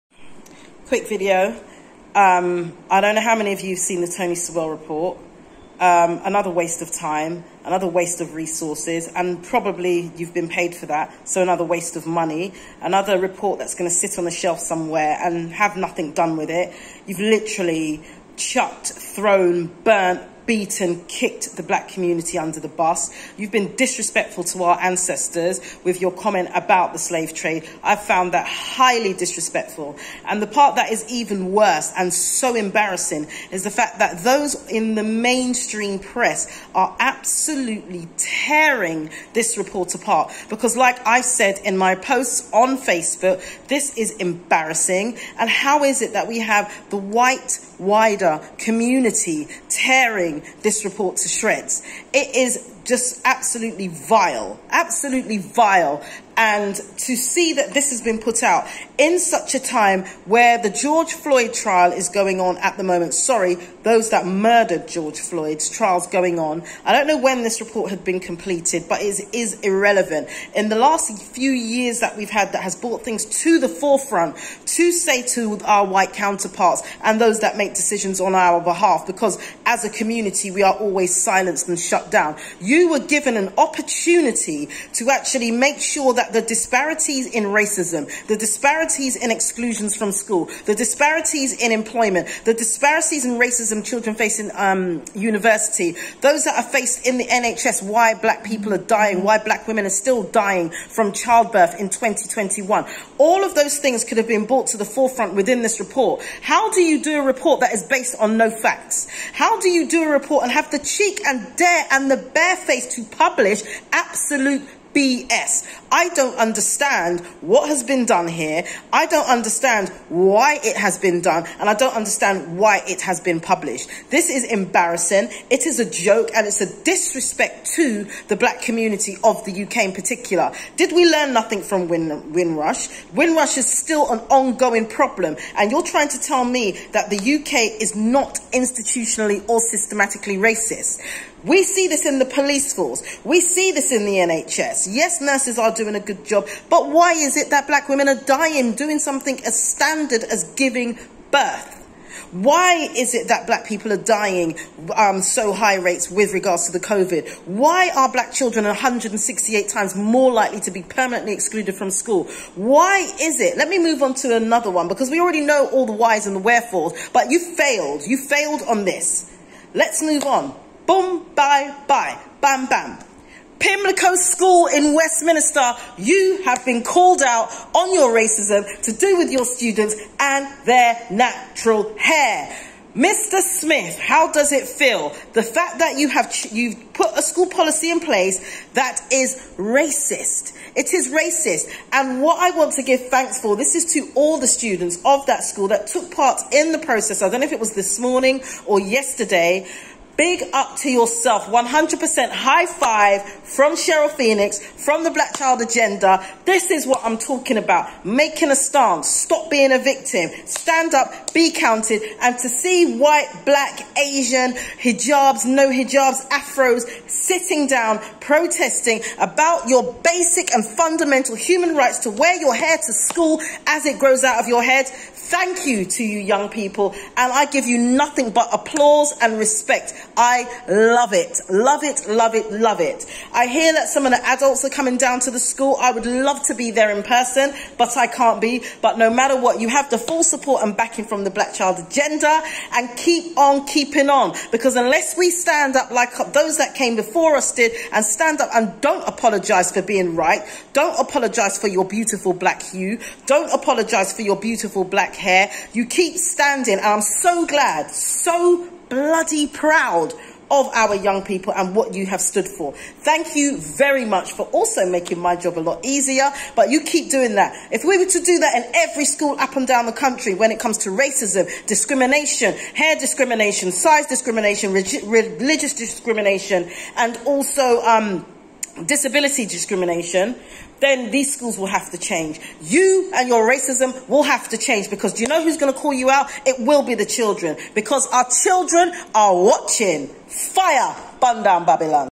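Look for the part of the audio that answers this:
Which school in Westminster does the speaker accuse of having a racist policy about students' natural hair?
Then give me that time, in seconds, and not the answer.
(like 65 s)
173 s.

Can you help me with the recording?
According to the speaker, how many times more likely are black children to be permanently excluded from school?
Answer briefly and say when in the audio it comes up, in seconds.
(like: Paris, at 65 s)
168, at 158 s.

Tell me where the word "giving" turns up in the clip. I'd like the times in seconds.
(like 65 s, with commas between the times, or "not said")
150 s.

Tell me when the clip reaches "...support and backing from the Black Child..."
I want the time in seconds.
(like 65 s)
240 s.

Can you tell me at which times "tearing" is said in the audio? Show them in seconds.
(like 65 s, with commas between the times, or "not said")
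38 s, 49 s.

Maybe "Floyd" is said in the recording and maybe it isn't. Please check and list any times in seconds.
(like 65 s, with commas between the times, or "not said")
61 s, 65 s.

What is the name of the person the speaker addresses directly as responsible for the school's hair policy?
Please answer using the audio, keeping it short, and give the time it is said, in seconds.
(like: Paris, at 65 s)
Mr. Smith, at 182 s.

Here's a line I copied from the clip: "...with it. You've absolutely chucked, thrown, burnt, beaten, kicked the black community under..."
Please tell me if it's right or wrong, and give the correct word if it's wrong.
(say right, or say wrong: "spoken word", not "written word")
wrong: "literally", not "absolutely".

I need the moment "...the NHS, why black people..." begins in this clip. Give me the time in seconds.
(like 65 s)
97 s.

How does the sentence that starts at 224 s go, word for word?
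Thank you to you young people.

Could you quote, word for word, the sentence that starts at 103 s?
All of those things could have been brought to the forefront within this report.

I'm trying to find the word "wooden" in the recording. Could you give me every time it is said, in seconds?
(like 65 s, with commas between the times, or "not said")
not said.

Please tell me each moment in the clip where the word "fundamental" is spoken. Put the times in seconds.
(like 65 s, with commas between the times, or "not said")
220 s.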